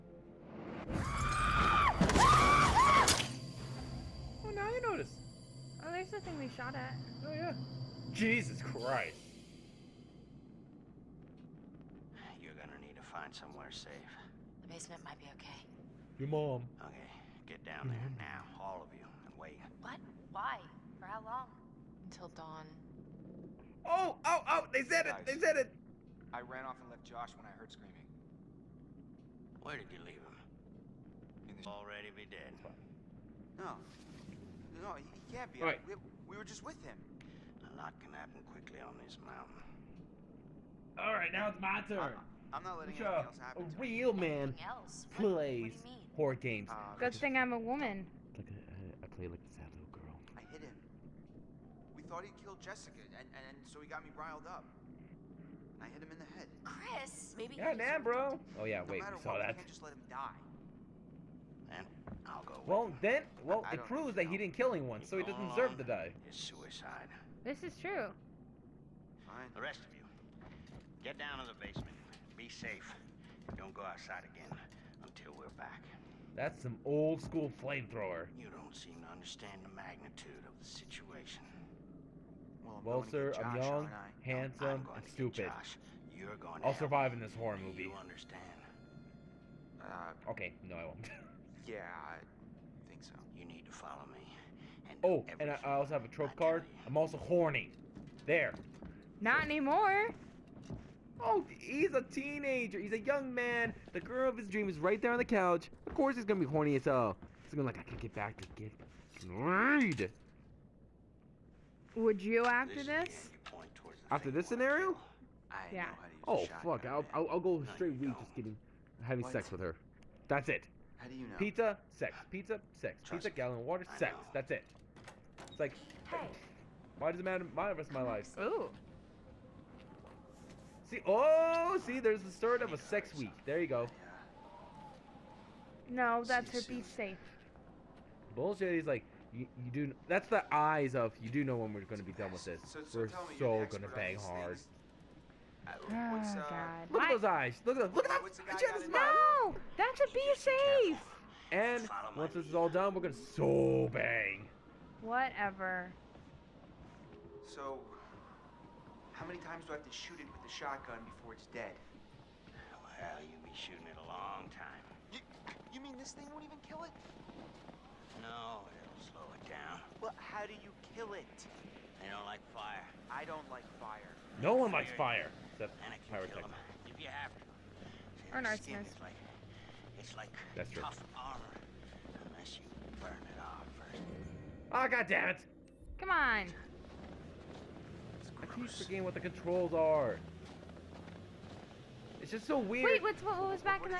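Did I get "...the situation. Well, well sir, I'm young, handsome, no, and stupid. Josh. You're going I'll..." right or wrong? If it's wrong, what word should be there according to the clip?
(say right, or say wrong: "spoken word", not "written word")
right.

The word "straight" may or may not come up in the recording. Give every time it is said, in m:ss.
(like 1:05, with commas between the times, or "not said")
1:57.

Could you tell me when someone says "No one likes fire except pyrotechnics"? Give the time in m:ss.
2:54.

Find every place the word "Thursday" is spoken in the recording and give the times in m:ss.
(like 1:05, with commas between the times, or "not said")
not said.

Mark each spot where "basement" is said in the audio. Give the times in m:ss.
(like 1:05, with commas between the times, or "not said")
0:14, 1:11.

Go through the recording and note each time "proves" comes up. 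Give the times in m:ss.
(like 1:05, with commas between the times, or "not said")
1:03.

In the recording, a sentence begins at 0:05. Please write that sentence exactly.
Oh, there's the thing we shot at.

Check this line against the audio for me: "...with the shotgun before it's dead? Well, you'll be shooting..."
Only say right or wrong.
right.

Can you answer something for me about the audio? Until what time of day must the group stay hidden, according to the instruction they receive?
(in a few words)
Until dawn.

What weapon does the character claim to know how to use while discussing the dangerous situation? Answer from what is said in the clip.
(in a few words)
A shotgun.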